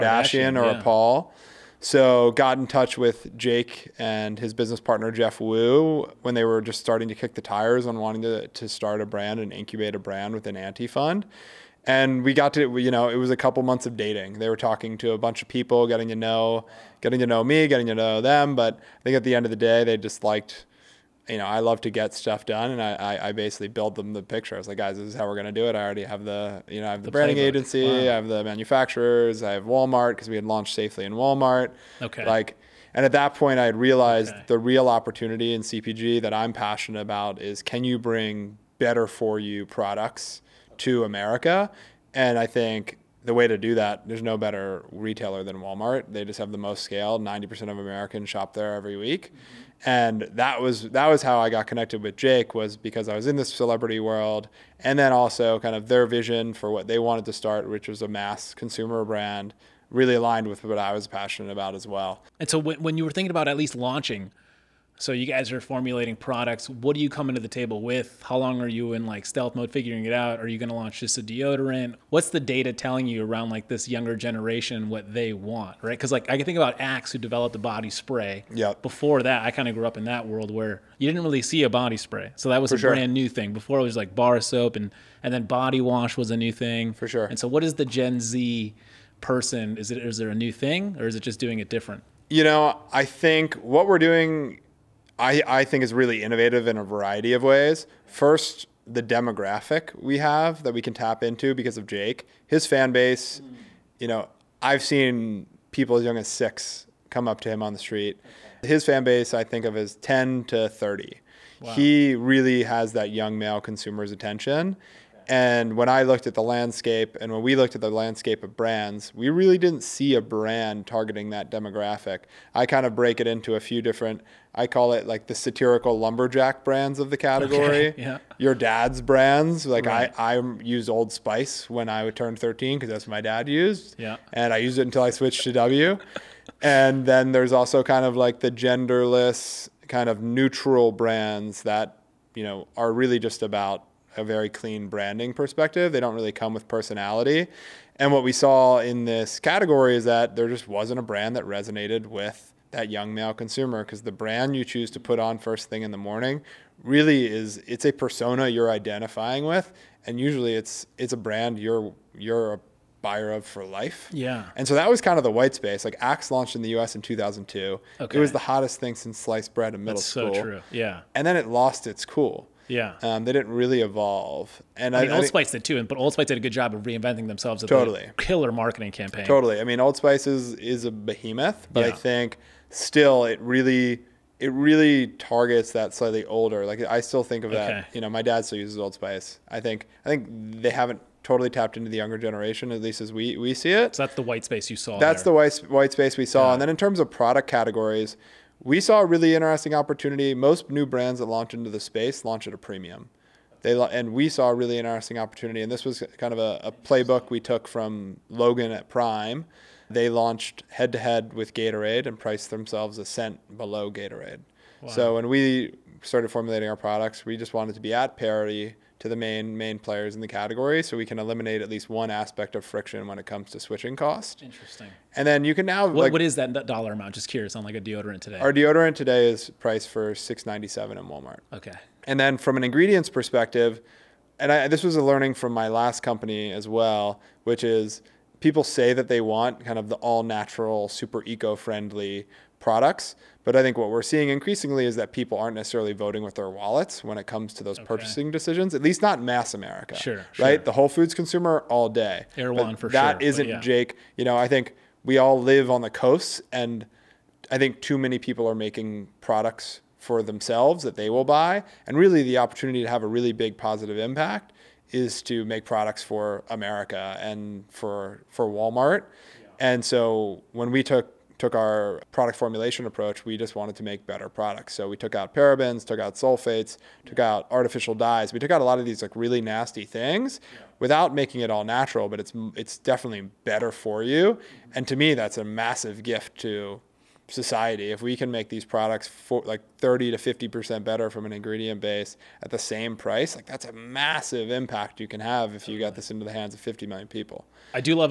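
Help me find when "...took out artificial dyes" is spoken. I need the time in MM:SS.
04:37.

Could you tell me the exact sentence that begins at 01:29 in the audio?
Is it is there a new thing or is it just doing it different?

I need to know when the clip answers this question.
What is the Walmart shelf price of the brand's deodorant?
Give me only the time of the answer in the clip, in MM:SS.
03:50.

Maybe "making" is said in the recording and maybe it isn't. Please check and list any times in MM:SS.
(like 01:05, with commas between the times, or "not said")
04:18, 04:41.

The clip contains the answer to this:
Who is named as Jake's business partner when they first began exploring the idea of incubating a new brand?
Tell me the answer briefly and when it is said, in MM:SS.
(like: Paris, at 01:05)
Jeff Woo, at 00:05.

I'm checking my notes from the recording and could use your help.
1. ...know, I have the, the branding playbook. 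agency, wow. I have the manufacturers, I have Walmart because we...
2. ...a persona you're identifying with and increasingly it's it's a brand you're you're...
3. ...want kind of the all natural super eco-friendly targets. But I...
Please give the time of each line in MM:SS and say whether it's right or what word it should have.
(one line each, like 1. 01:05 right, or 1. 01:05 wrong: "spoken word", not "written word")
1. 00:26 right
2. 02:37 wrong: "usually", not "increasingly"
3. 03:59 wrong: "products", not "targets".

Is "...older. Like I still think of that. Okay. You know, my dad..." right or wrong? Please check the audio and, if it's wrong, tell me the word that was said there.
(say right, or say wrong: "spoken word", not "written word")
right.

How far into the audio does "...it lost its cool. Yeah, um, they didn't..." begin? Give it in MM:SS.
02:51.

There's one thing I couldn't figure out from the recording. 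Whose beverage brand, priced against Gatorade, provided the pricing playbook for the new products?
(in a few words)
Logan.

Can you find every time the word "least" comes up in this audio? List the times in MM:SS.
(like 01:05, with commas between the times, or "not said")
01:03, 03:12, 03:41, 04:08.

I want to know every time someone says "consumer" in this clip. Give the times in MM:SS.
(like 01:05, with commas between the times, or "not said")
00:58, 01:53, 02:33, 04:11.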